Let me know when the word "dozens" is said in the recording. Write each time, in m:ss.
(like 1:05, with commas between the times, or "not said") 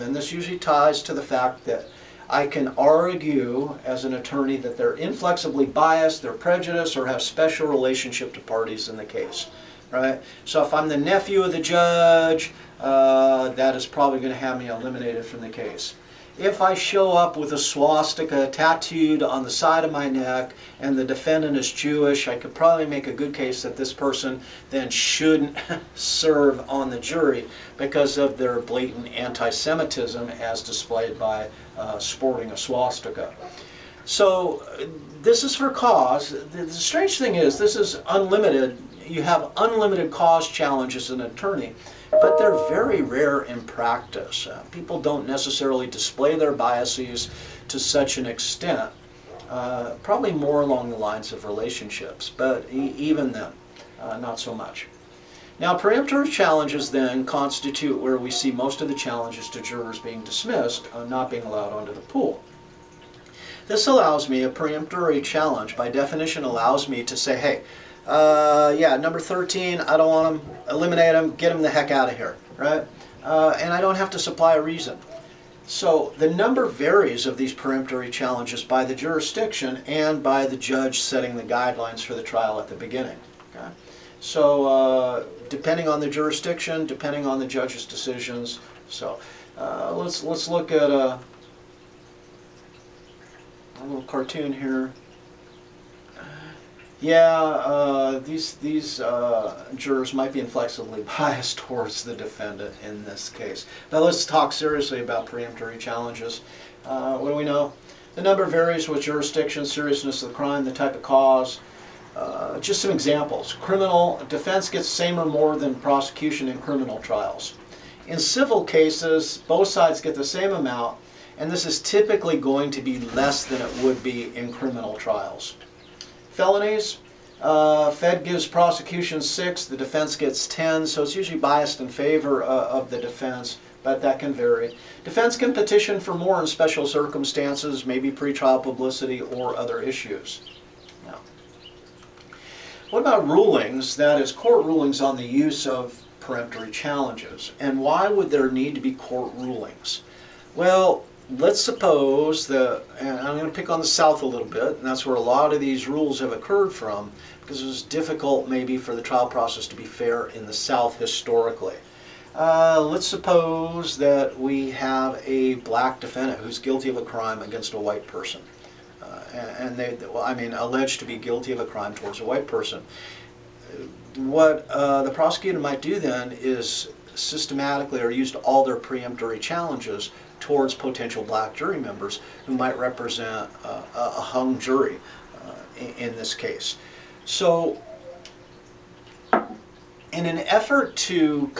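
not said.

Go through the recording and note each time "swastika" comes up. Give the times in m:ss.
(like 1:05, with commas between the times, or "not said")
0:17, 0:32.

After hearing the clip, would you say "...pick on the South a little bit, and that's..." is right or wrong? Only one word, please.
right.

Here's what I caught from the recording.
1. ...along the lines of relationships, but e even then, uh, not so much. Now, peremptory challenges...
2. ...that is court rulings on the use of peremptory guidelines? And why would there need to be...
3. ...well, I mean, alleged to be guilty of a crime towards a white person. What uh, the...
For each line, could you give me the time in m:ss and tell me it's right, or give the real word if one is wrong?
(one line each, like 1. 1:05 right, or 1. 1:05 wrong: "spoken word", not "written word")
1. 0:50 right
2. 2:23 wrong: "challenges", not "guidelines"
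3. 2:50 right.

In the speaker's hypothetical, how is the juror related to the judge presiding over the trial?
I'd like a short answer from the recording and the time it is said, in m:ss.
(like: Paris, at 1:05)
Nephew, at 0:10.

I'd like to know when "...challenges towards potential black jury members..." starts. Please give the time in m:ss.
2:59.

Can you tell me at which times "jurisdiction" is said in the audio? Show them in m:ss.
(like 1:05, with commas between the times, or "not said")
1:18, 1:26, 1:49.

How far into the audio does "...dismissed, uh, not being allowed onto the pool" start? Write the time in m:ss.
1:00.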